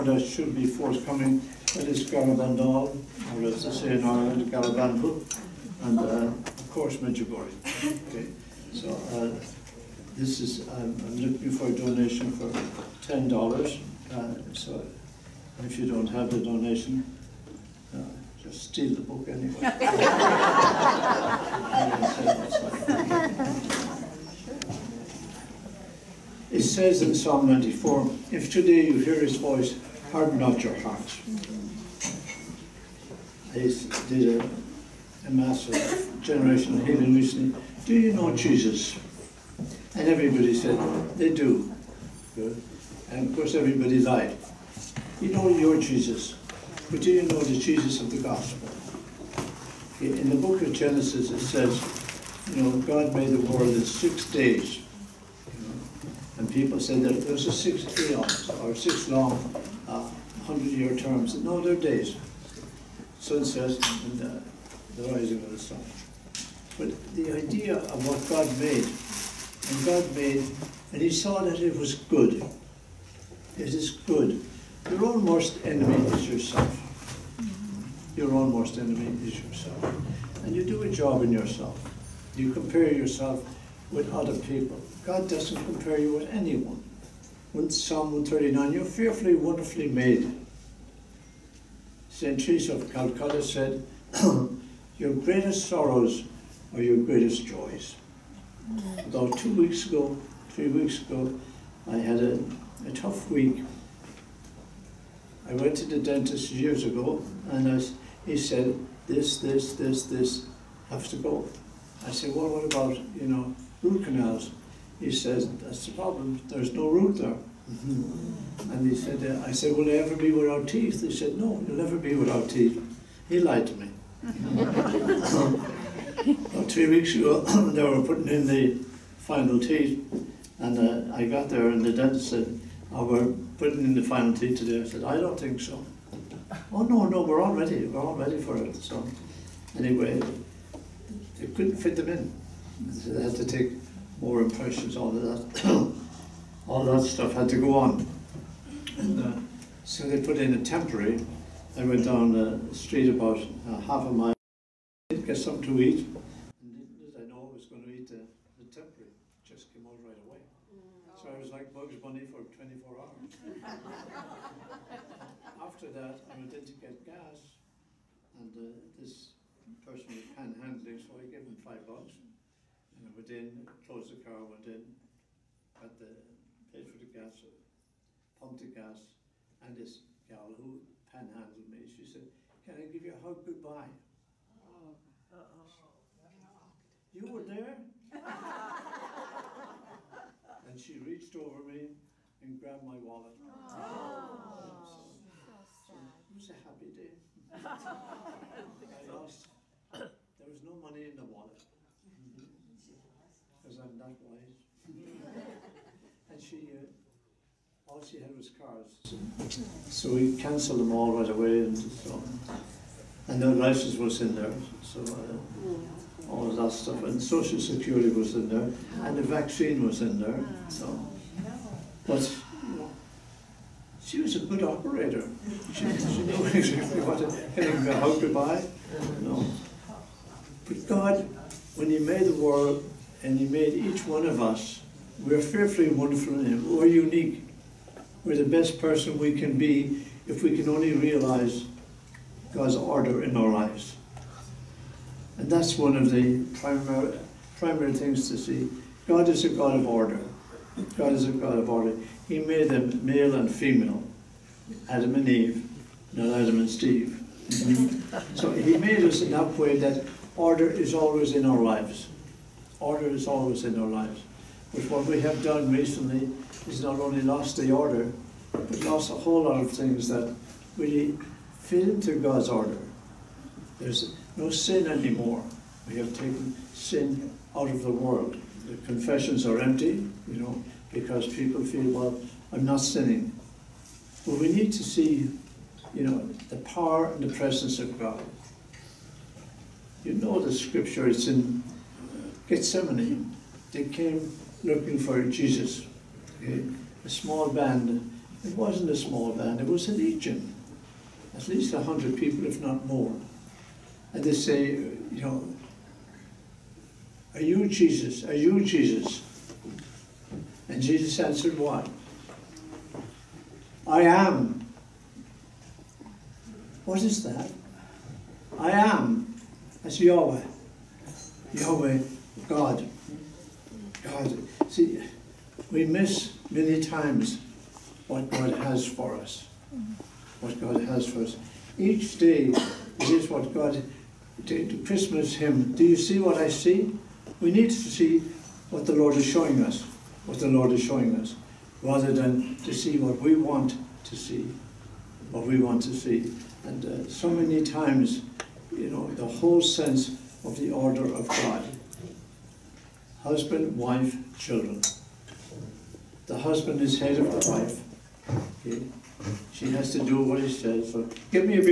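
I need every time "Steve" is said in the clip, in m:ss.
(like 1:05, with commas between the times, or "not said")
4:16.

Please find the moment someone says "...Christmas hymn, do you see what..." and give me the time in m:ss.
5:34.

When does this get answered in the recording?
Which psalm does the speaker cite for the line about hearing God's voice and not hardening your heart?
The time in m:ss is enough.
0:27.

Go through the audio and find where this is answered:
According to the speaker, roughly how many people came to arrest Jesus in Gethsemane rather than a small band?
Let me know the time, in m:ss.
5:01.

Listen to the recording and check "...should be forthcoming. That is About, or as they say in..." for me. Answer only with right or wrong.
wrong.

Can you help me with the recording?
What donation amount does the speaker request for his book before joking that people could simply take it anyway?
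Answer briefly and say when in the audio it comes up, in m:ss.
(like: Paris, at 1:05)
$10, at 0:13.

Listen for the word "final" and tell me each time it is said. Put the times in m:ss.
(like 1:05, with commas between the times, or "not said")
2:09, 2:14.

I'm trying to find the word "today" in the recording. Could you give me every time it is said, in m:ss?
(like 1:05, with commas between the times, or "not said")
0:28, 2:14.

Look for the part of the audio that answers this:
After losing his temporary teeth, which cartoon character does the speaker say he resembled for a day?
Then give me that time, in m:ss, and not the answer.
2:41.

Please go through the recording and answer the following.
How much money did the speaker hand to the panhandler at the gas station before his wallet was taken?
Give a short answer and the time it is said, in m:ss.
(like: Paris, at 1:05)
$5, at 2:51.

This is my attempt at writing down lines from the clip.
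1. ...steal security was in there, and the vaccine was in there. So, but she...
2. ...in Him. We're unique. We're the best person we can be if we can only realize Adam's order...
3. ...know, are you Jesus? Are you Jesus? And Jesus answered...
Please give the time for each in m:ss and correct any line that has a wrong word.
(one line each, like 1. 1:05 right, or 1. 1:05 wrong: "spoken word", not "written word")
1. 3:37 wrong: "social", not "steal"
2. 3:56 wrong: "God", not "Adam"
3. 5:05 right.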